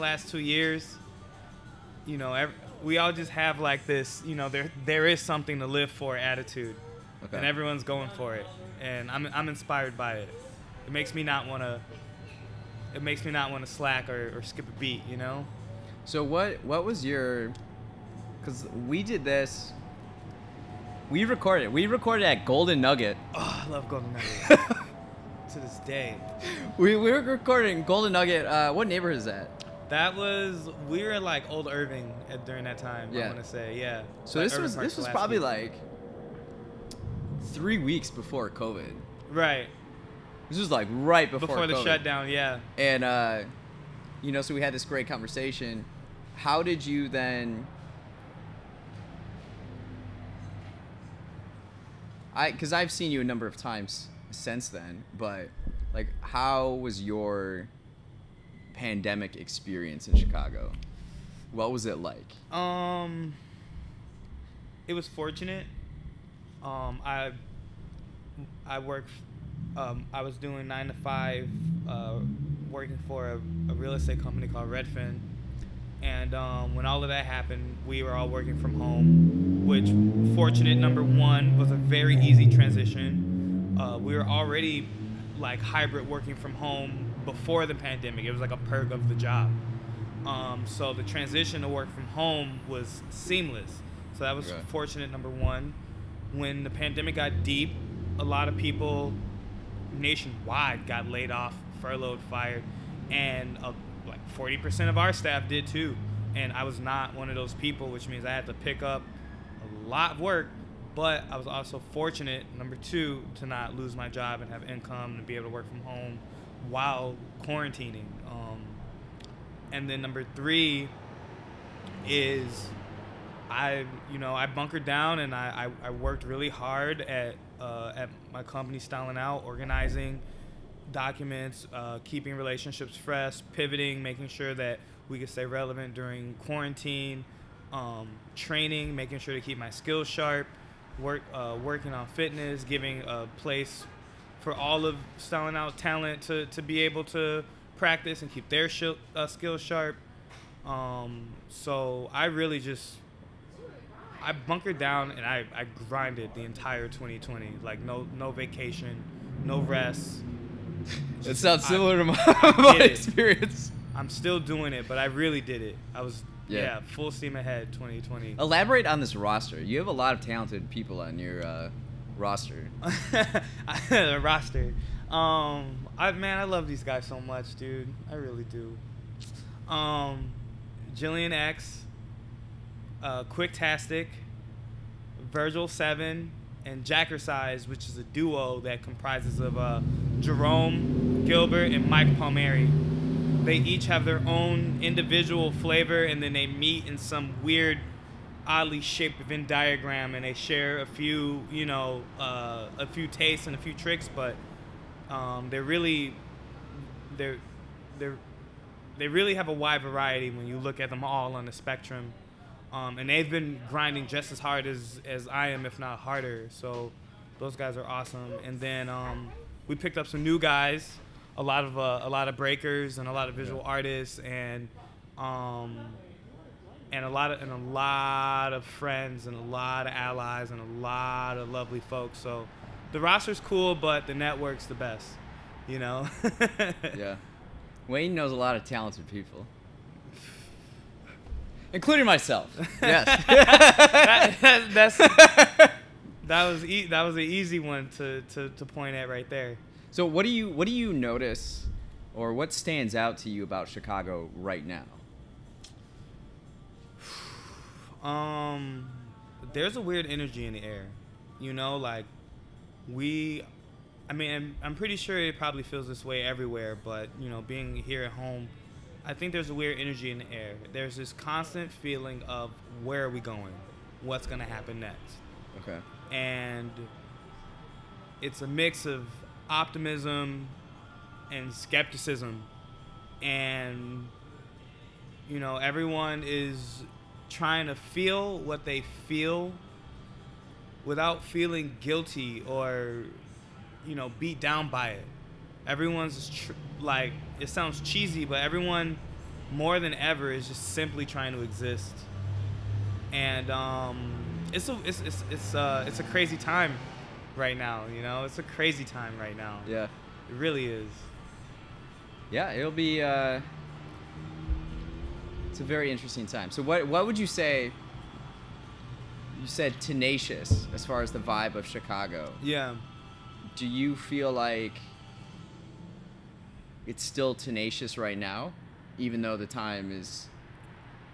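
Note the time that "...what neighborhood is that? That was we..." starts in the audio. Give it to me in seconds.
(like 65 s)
28 s.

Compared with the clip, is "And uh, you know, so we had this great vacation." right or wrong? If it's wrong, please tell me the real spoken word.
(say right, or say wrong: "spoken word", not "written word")
wrong: "conversation", not "vacation".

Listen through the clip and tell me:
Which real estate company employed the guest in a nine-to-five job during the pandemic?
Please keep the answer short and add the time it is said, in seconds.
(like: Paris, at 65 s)
Redfin, at 74 s.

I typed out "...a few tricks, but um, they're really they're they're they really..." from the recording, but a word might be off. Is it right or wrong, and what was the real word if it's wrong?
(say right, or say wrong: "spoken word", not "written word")
right.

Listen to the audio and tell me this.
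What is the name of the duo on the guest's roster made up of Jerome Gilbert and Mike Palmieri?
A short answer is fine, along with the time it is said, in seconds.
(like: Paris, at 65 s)
Jackersize, at 186 s.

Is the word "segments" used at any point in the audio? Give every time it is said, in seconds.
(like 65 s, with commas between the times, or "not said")
not said.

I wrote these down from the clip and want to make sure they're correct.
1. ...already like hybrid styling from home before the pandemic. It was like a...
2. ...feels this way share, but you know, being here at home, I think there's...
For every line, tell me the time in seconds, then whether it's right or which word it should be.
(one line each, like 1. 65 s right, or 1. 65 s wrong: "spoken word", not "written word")
1. 84 s wrong: "working", not "styling"
2. 265 s wrong: "everywhere", not "share".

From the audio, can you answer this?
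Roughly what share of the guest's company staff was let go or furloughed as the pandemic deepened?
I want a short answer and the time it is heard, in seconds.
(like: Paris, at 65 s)
40%, at 104 s.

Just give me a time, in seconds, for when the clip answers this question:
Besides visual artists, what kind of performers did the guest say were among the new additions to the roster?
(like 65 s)
222 s.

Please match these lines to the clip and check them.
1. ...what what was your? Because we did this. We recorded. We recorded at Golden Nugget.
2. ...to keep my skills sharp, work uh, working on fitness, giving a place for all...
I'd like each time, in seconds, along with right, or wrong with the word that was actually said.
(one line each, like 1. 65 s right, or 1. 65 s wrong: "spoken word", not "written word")
1. 16 s right
2. 139 s right.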